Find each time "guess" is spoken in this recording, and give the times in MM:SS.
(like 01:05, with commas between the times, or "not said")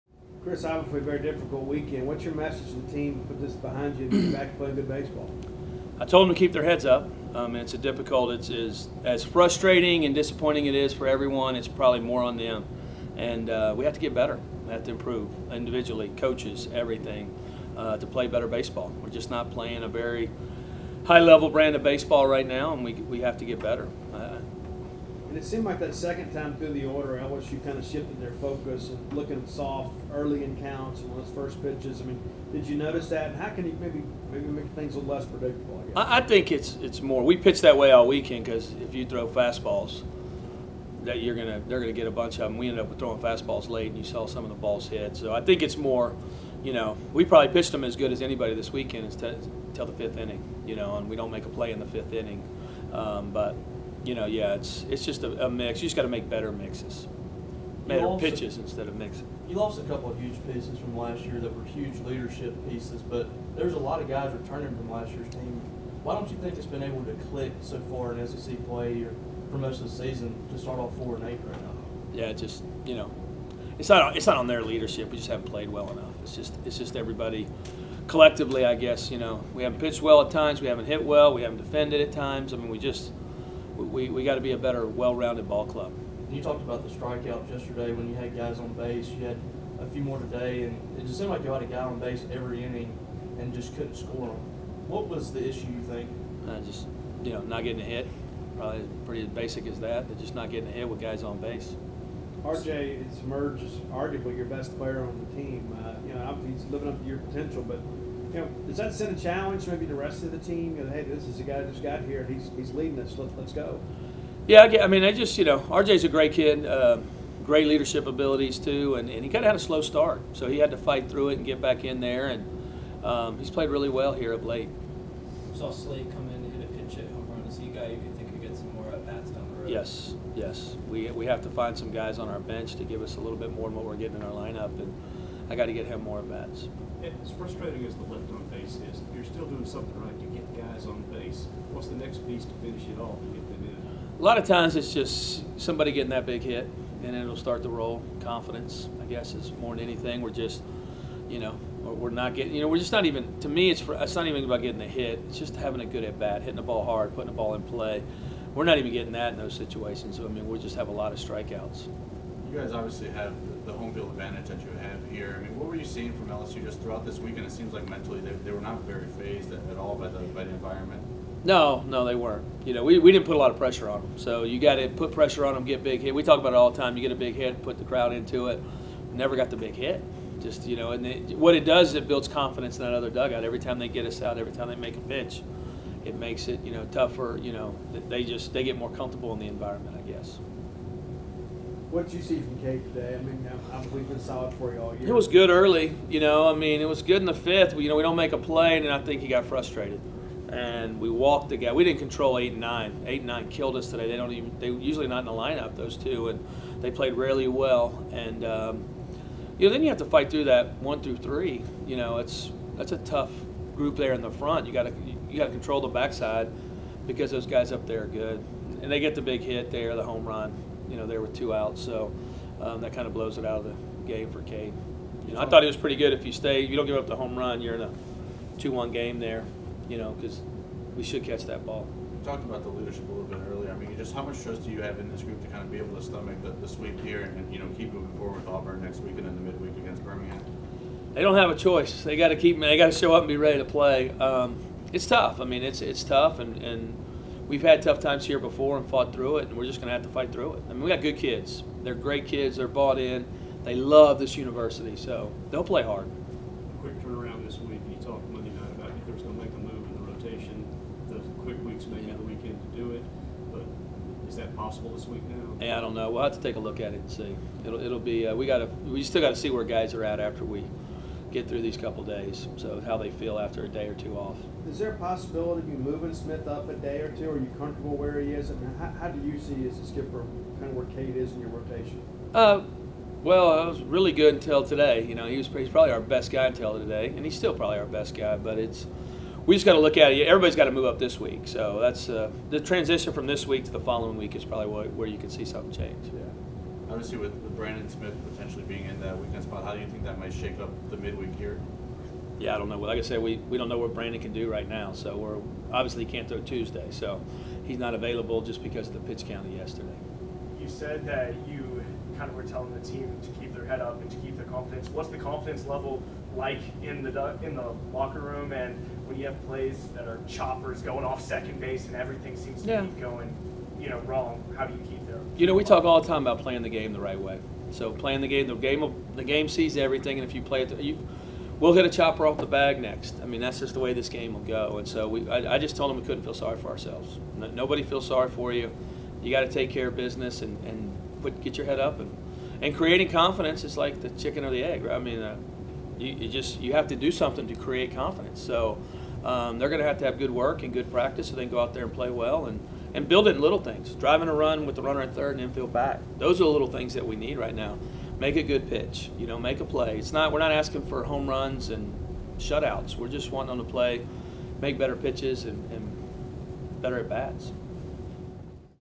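01:18, 02:29, 03:10.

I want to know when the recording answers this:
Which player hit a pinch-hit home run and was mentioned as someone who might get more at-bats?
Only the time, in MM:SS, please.
02:05.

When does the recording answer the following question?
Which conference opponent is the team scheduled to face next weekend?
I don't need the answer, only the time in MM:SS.
03:58.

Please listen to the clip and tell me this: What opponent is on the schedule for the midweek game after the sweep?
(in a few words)
Birmingham.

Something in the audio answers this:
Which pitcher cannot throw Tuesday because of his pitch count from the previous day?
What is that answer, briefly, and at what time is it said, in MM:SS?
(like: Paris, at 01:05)
Brandon Smith, at 04:57.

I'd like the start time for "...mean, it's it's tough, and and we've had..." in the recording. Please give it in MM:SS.
04:05.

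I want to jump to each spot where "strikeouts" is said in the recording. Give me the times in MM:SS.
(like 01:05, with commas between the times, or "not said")
01:26, 02:41.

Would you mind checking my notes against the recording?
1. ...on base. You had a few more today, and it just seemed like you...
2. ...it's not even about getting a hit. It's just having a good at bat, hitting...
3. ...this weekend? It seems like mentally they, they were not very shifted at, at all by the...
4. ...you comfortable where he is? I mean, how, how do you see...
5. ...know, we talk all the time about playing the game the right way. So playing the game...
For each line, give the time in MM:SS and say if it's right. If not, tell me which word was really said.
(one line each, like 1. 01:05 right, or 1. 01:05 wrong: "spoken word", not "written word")
1. 01:28 right
2. 02:33 right
3. 02:47 wrong: "phased", not "shifted"
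4. 04:37 right
5. 05:25 right.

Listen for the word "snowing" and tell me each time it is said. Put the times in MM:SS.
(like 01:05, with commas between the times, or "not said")
not said.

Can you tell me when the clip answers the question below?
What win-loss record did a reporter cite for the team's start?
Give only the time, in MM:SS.
01:10.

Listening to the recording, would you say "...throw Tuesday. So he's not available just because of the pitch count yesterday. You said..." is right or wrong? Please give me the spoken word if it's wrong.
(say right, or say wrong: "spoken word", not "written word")
right.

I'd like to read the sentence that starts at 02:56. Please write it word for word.
We talk about it all the time.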